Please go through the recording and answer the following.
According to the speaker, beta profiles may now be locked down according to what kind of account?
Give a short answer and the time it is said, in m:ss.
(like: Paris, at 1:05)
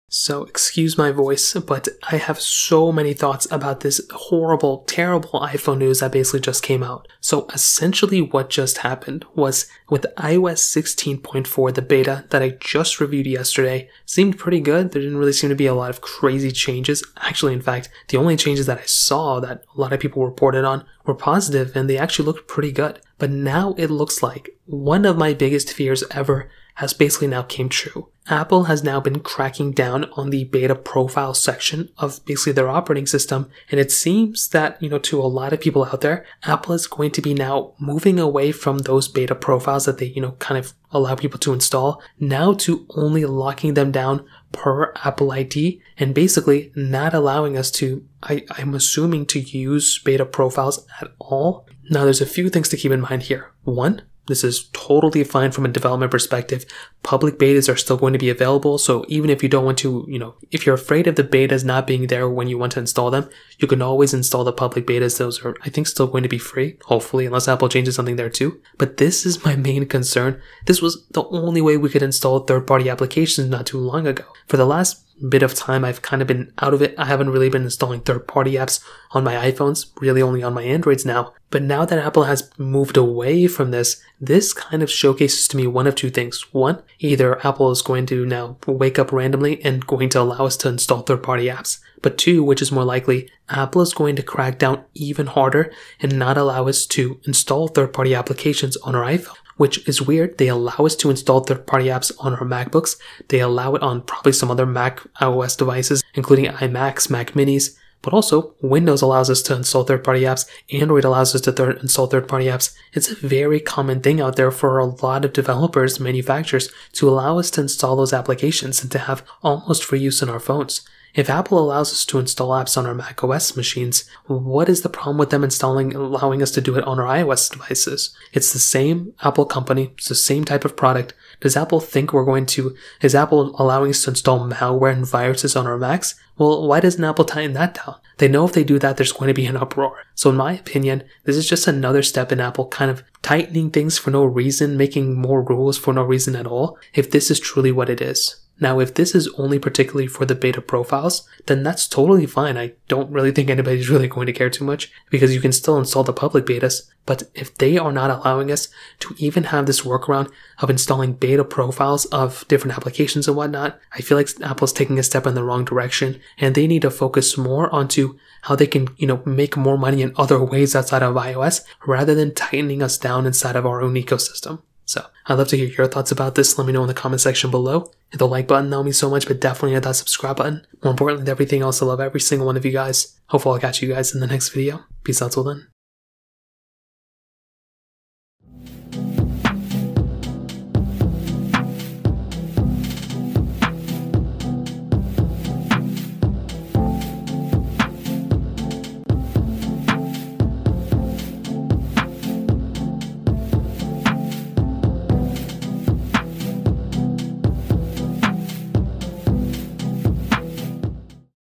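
Apple ID, at 0:45.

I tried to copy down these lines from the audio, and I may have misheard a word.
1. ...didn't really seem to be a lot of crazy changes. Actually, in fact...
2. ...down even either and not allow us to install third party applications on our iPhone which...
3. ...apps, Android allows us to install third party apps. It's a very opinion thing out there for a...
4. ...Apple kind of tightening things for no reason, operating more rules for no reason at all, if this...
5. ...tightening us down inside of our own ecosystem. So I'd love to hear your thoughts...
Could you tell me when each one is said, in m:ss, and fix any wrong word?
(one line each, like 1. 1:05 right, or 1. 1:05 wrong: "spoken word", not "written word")
1. 0:15 right
2. 1:34 wrong: "harder", not "either"
3. 1:50 wrong: "common", not "opinion"
4. 2:22 wrong: "making", not "operating"
5. 2:52 right.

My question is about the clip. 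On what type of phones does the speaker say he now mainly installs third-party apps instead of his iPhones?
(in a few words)
Androids.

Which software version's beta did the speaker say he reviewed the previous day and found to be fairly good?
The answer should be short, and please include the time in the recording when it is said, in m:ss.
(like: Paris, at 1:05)
iOS 16.4, at 0:10.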